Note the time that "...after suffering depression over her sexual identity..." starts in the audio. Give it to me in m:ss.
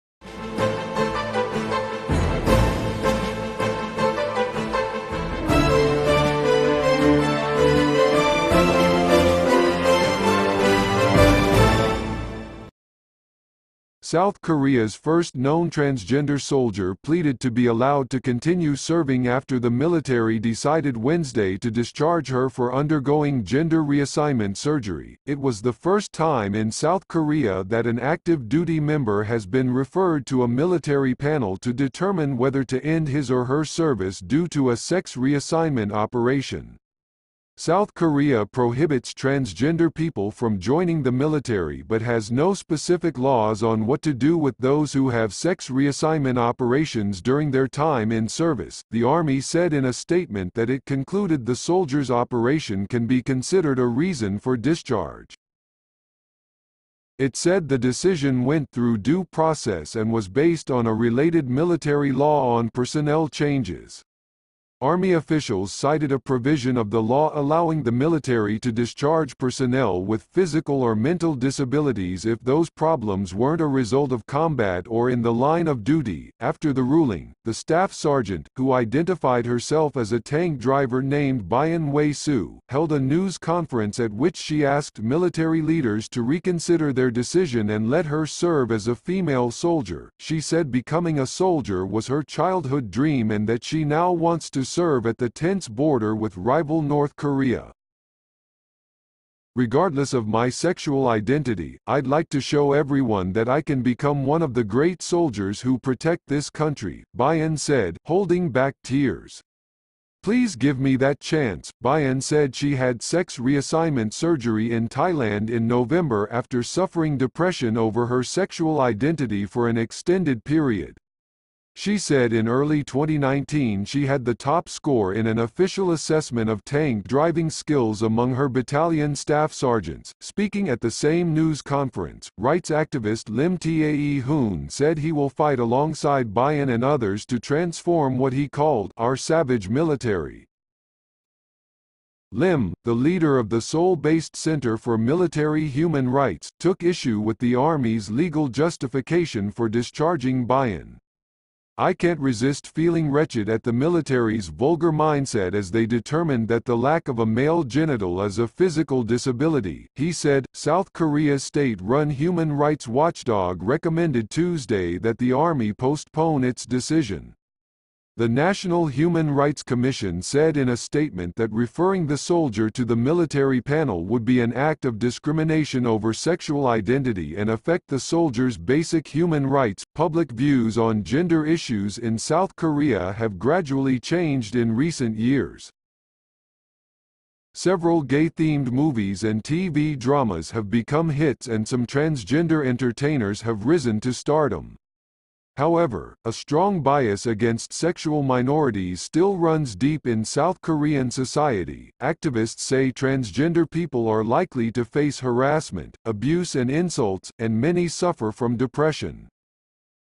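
1:56.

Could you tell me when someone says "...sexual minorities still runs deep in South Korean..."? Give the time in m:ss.
3:17.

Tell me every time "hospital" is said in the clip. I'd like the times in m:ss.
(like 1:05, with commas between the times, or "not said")
not said.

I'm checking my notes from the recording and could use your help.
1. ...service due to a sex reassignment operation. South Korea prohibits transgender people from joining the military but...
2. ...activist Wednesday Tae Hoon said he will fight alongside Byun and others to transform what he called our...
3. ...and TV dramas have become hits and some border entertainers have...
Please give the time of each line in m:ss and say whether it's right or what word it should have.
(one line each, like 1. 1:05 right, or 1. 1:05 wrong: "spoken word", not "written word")
1. 0:33 right
2. 2:12 wrong: "Lim", not "Wednesday"
3. 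3:09 wrong: "transgender", not "border".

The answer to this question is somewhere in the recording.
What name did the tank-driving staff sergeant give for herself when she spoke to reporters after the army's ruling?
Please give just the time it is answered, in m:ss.
1:21.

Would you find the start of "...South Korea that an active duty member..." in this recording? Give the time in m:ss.
0:26.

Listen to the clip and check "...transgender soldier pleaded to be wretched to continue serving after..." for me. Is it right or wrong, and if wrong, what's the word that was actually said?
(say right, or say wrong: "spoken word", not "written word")
wrong: "allowed", not "wretched".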